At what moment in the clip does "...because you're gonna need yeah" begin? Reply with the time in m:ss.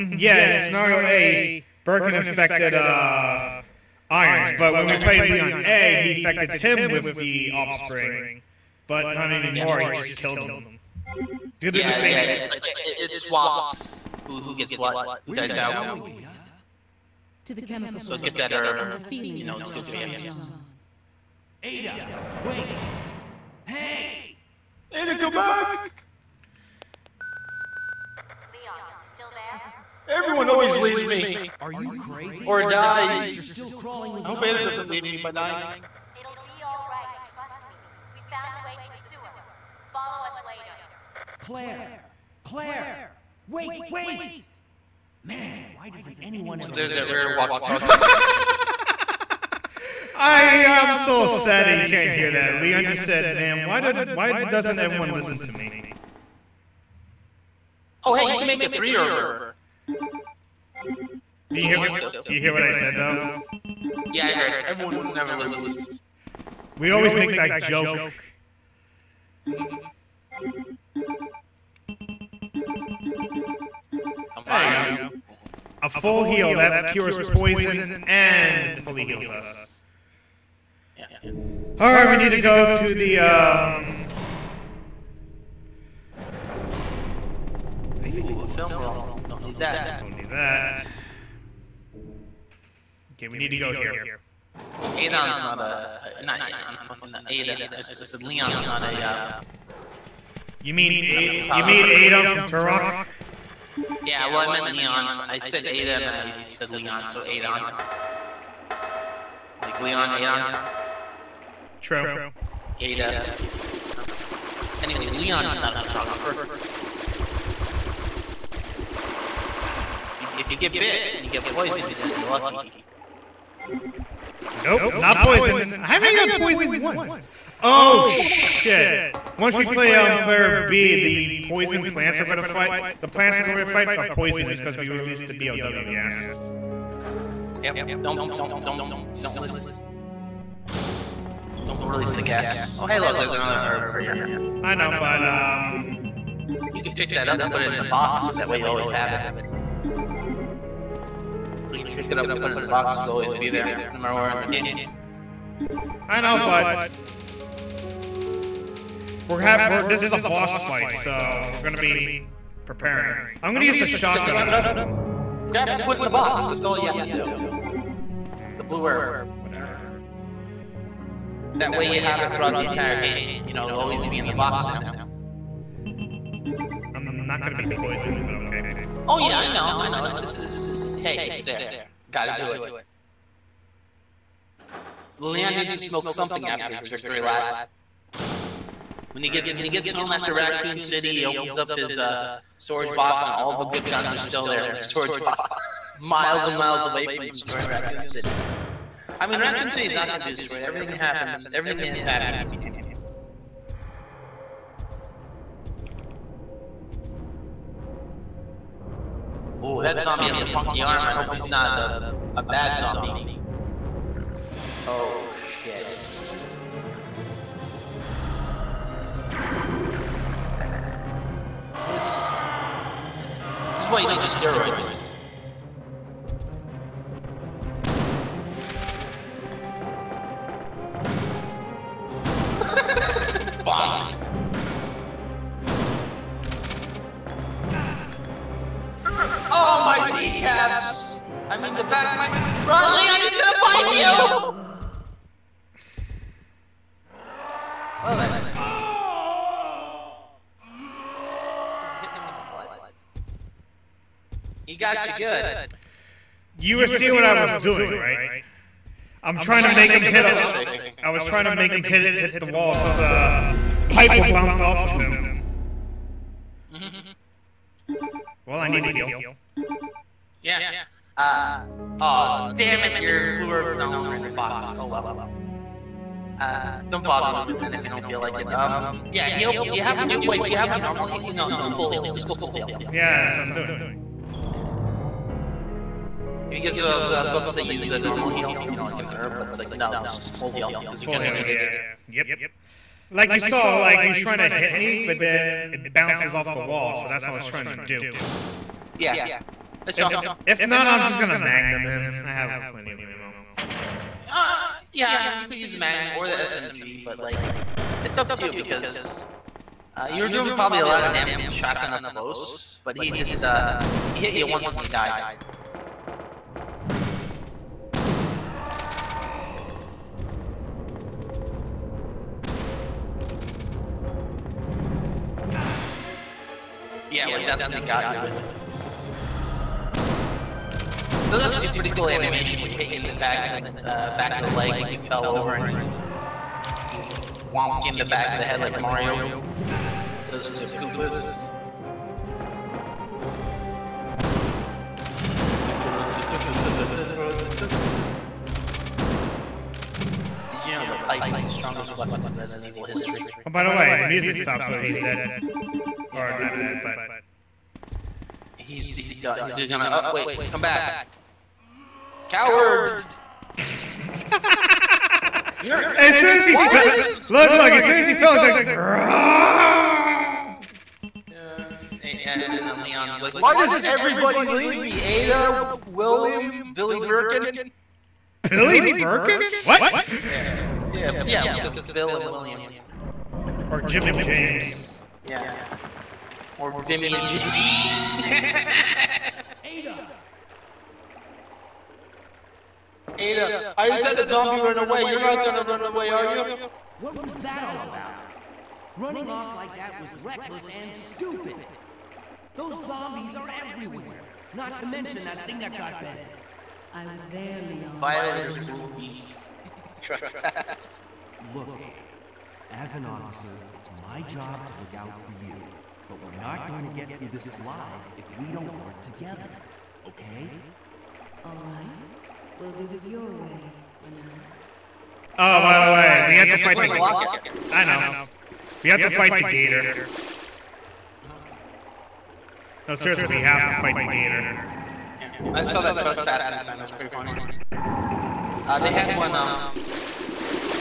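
4:50.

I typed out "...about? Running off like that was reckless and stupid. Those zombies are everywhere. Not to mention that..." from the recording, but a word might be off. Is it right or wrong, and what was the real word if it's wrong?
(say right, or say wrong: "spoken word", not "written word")
right.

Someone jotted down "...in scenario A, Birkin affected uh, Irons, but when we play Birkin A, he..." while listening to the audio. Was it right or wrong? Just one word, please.
wrong.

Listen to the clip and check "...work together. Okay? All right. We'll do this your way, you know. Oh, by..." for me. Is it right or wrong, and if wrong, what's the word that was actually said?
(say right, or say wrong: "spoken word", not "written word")
right.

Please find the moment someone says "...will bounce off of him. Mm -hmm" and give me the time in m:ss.
4:24.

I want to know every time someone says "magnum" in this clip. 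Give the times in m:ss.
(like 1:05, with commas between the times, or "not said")
5:01, 5:05.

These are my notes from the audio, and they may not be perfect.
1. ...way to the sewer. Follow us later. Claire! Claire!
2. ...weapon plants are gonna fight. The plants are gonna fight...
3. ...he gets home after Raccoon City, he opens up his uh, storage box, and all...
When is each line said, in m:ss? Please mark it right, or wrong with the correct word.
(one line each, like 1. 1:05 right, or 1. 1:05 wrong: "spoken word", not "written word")
1. 0:38 right
2. 2:11 wrong: "poison", not "weapon"
3. 3:09 right.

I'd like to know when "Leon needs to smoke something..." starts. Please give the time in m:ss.
3:05.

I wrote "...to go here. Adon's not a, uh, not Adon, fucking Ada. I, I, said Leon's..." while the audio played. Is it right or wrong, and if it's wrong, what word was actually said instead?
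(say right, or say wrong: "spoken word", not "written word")
right.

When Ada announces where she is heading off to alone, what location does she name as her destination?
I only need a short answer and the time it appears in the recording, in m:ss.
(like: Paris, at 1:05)
The chemical plant, at 0:17.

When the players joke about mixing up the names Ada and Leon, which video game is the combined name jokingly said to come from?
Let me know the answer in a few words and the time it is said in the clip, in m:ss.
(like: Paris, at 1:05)
Turok, at 1:42.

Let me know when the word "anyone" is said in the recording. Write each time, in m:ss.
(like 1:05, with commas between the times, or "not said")
0:46.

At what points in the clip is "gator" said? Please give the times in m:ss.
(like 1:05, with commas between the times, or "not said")
7:09, 7:14.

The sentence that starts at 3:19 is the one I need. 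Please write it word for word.
I mean, I'm not going to say he's not going to be destroyed.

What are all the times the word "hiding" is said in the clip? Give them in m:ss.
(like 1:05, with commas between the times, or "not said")
not said.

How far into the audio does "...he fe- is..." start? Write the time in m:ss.
6:06.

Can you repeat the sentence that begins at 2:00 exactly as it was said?
If you get bit, you get poisoned, then you're lucky.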